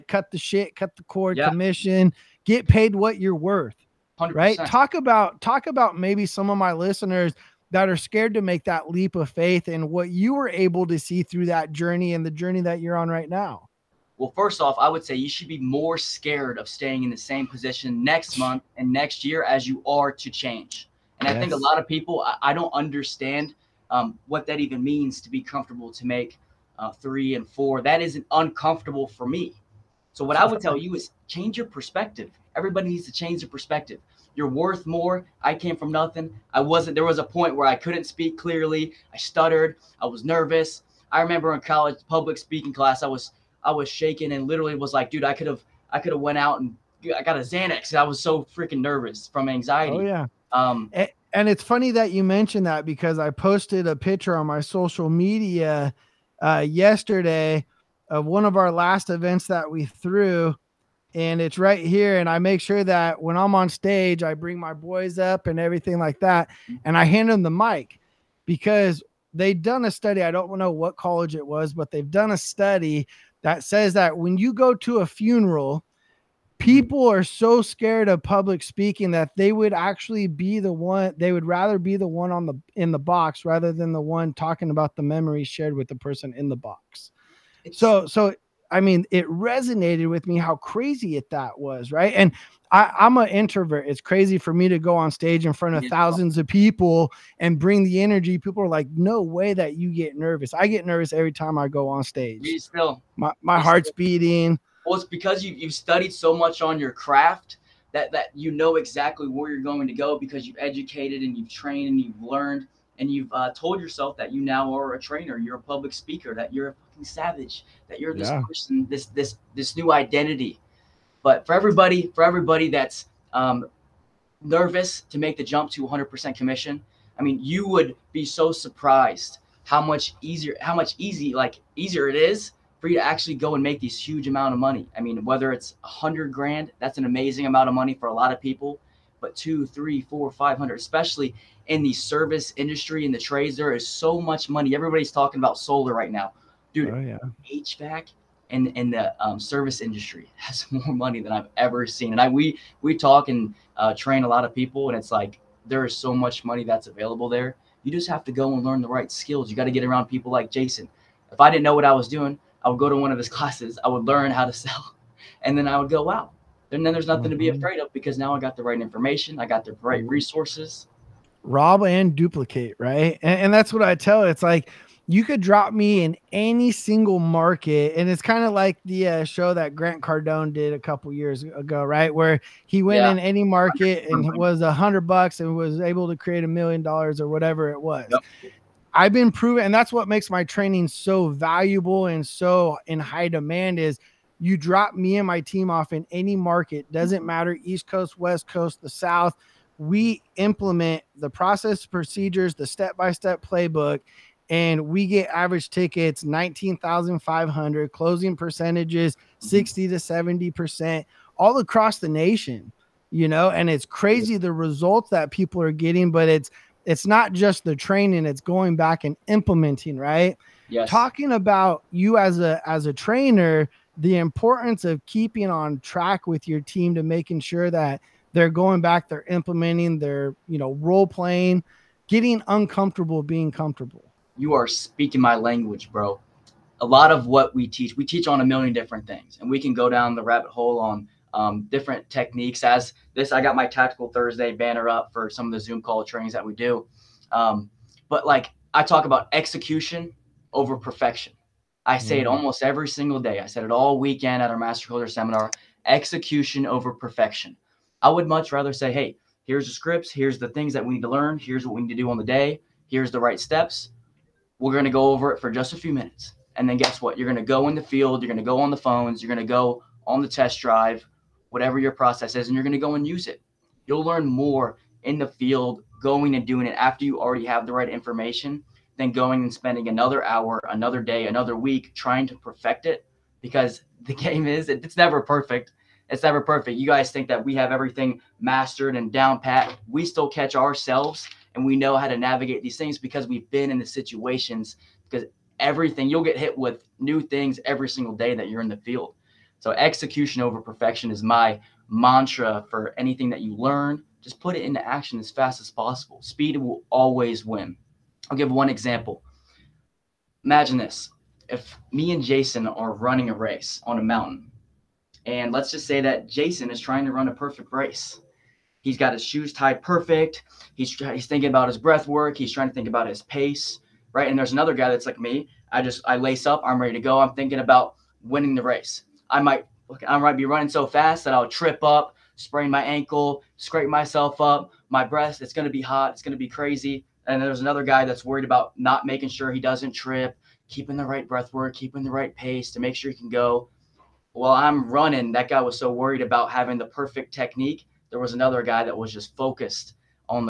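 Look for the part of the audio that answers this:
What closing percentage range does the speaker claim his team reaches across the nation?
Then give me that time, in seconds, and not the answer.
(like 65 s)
209 s.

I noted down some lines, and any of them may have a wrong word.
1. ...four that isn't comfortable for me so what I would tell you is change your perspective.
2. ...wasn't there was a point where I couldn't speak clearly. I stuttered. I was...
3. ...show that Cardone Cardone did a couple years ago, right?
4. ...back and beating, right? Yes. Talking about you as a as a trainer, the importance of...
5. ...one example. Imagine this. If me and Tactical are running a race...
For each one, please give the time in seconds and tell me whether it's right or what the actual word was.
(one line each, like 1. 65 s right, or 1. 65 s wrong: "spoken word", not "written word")
1. 27 s wrong: "uncomfortable", not "comfortable"
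2. 36 s right
3. 179 s wrong: "Grant", not "Cardone"
4. 218 s wrong: "implementing", not "beating"
5. 308 s wrong: "Jason", not "Tactical".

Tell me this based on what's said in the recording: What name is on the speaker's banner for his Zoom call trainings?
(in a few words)
Tactical Thursday.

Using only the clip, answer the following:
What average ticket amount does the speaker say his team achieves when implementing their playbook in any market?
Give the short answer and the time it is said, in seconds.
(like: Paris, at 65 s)
19,500, at 206 s.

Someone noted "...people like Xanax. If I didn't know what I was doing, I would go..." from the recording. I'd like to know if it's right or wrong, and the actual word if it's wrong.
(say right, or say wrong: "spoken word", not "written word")
wrong: "Jason", not "Xanax".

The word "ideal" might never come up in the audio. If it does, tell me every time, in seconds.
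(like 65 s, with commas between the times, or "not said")
not said.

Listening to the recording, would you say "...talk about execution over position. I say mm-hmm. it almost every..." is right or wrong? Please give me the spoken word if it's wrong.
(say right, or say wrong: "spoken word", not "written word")
wrong: "perfection", not "position".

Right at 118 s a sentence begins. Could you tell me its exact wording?
person, this this this new identity.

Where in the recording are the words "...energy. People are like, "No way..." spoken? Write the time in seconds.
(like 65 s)
98 s.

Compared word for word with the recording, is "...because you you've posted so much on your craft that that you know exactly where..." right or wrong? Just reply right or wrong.
wrong.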